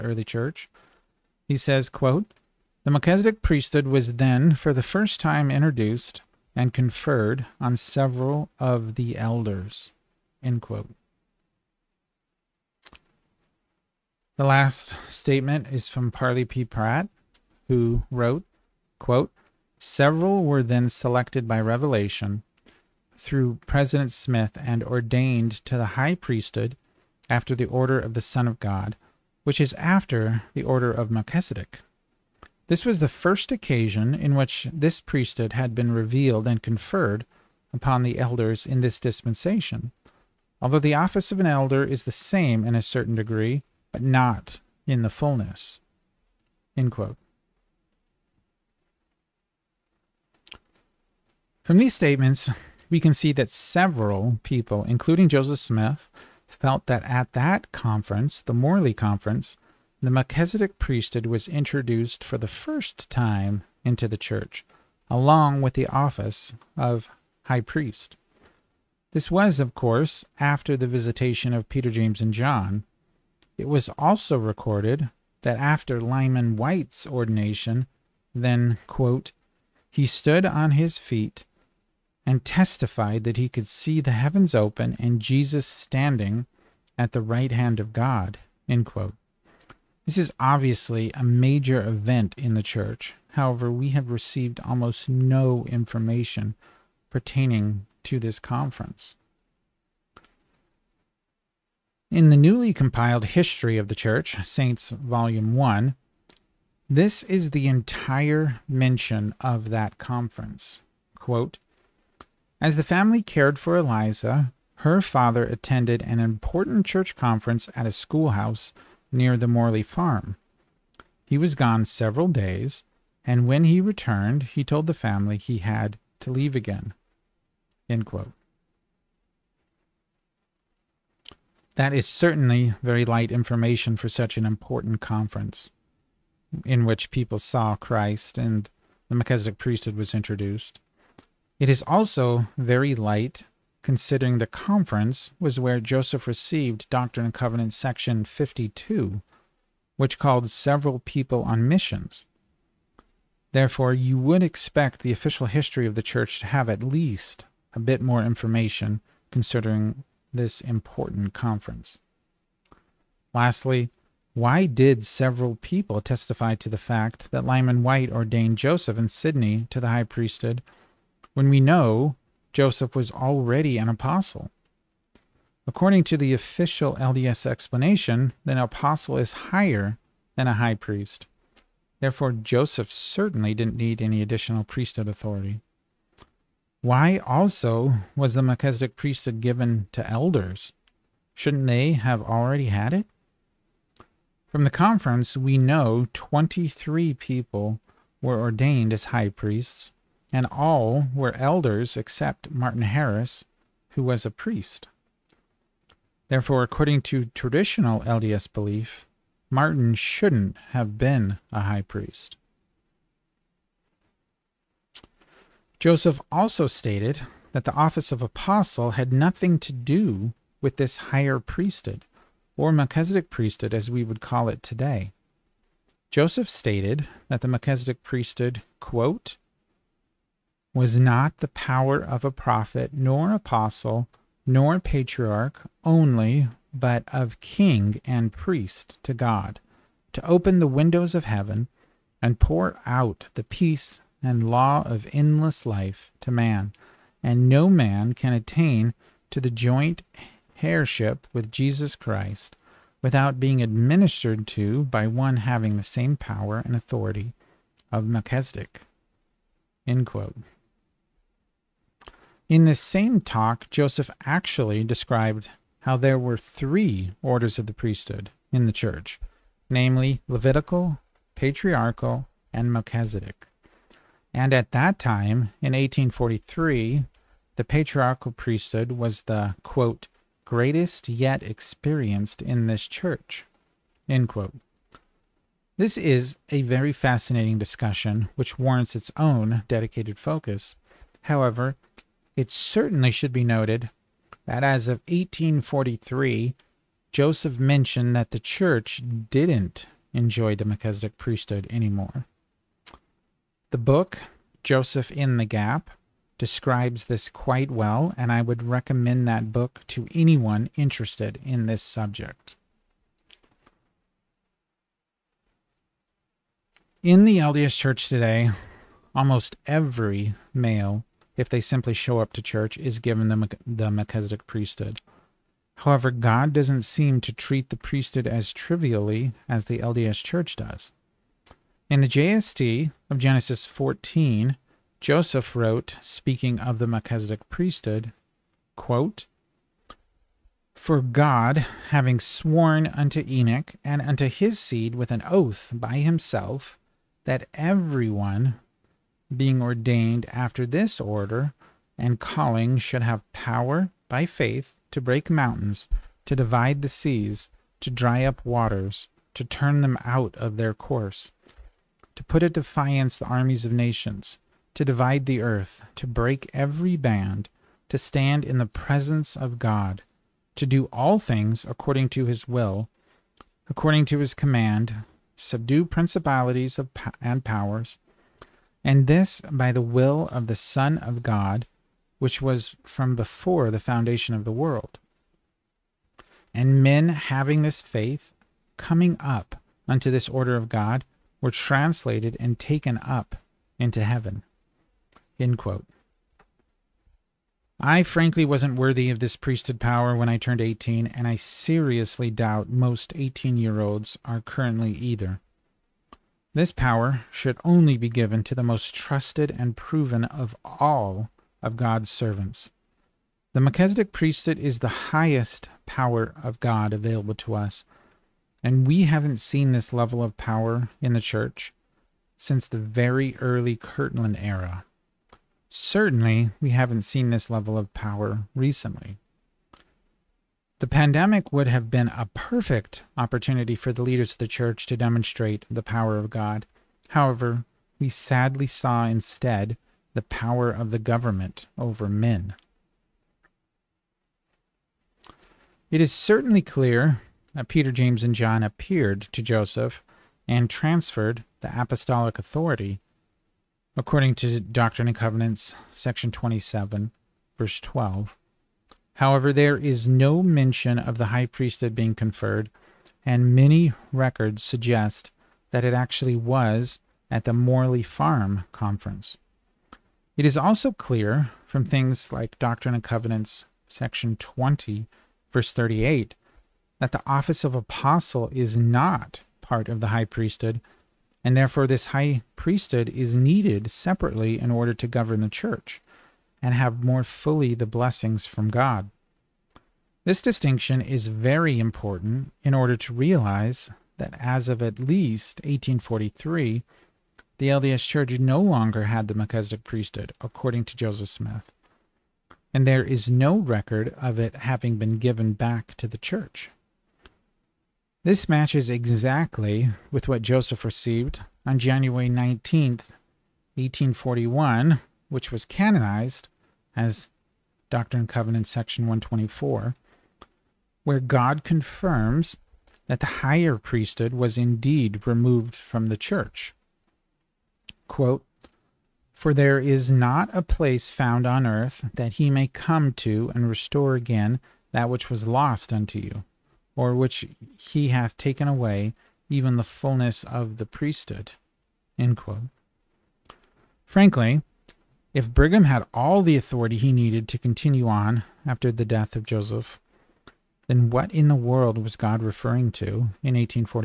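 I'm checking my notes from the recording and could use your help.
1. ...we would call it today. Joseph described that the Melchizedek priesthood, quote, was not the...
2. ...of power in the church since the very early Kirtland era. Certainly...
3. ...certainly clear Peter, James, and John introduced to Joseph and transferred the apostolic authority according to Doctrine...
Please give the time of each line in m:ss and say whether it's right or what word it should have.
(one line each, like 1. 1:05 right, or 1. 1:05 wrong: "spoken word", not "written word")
1. 3:43 wrong: "stated", not "described"
2. 7:00 right
3. 7:26 wrong: "appeared", not "introduced".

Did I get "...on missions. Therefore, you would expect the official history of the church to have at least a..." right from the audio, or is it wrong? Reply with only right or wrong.
right.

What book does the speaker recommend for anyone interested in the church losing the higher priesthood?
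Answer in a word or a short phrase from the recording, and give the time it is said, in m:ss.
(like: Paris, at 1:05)
Joseph in the Gap, at 5:04.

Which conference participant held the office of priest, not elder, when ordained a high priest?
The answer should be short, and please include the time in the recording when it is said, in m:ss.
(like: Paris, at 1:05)
Martin Harris, at 3:22.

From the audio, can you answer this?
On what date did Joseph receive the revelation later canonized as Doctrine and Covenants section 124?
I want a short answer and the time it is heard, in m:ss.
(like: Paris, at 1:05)
January 19th, 1841, at 8:31.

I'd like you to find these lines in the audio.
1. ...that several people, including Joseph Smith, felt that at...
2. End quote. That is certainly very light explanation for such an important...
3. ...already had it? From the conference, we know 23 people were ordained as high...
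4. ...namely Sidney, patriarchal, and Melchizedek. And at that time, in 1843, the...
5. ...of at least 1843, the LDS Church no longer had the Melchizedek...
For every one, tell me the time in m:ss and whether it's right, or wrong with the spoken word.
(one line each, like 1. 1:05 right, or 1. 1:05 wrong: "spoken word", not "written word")
1. 0:53 right
2. 2:07 wrong: "information", not "explanation"
3. 3:12 right
4. 4:29 wrong: "Levitical", not "Sidney"
5. 8:14 right.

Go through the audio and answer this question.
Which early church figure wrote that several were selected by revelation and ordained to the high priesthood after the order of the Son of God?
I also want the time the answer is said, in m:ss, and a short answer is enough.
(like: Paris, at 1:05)
Parley P. Pratt, at 0:16.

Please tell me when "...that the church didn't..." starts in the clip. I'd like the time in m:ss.
4:58.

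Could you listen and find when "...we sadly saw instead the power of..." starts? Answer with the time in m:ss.
7:17.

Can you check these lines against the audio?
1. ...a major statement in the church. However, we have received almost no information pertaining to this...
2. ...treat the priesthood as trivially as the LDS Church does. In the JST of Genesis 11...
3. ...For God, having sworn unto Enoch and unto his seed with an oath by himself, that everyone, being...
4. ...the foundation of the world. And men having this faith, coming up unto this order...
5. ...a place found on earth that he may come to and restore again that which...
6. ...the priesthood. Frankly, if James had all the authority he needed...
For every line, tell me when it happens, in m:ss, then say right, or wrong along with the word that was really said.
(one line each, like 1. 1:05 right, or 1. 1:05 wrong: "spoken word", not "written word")
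1. 1:31 wrong: "event", not "statement"
2. 5:27 wrong: "14", not "11"
3. 5:40 right
4. 6:23 right
5. 8:50 right
6. 9:00 wrong: "Brigham", not "James".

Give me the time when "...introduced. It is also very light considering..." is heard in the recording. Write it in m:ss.
2:20.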